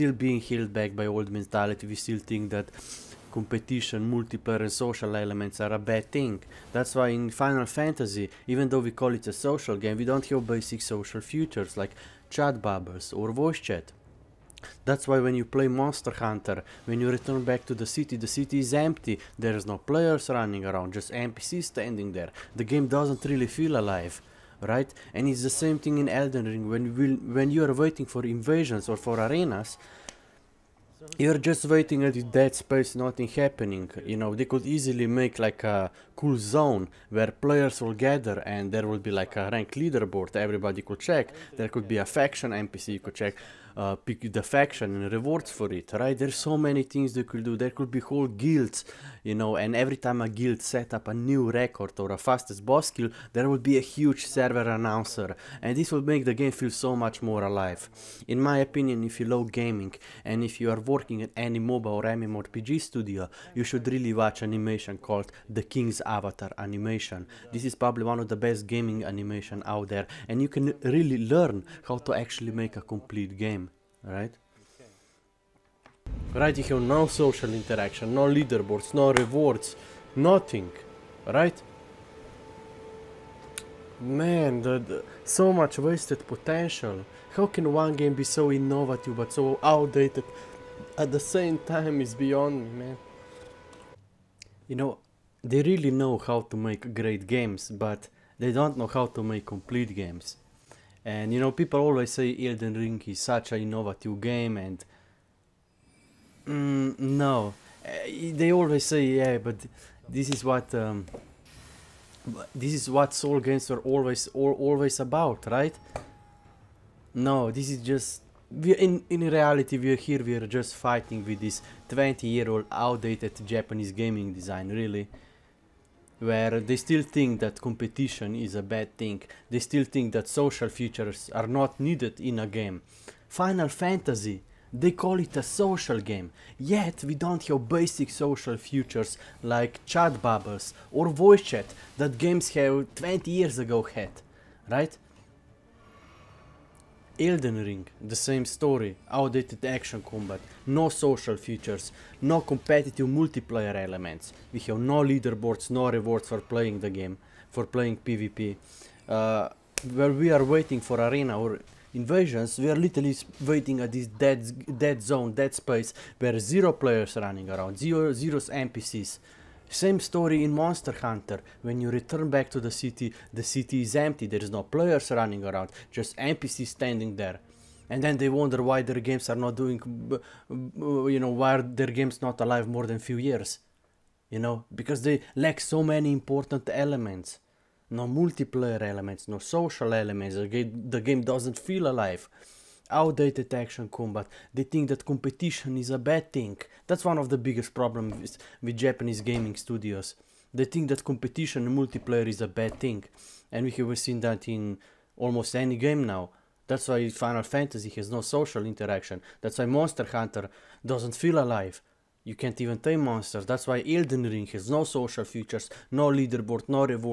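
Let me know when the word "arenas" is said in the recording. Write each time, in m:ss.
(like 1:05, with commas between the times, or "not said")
0:29, 2:40.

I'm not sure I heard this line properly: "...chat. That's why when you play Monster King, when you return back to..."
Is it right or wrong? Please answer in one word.
wrong.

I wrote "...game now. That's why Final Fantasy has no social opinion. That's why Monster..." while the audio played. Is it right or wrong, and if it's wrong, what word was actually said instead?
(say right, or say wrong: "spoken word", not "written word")
wrong: "interaction", not "opinion".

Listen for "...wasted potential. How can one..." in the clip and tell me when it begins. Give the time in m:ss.
1:25.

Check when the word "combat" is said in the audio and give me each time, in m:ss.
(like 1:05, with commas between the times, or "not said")
2:30, 3:13.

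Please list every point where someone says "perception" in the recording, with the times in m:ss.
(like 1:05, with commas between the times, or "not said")
not said.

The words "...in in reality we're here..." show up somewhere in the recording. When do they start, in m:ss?
1:58.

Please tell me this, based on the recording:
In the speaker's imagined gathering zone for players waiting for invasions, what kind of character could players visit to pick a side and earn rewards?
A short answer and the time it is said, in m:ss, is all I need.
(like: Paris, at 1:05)
Faction NPC, at 0:42.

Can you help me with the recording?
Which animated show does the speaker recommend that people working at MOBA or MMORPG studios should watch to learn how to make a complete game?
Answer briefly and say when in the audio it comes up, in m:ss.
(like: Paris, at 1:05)
The King's Avatar, at 1:05.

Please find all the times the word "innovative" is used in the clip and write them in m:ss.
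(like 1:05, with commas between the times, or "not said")
1:28, 1:43.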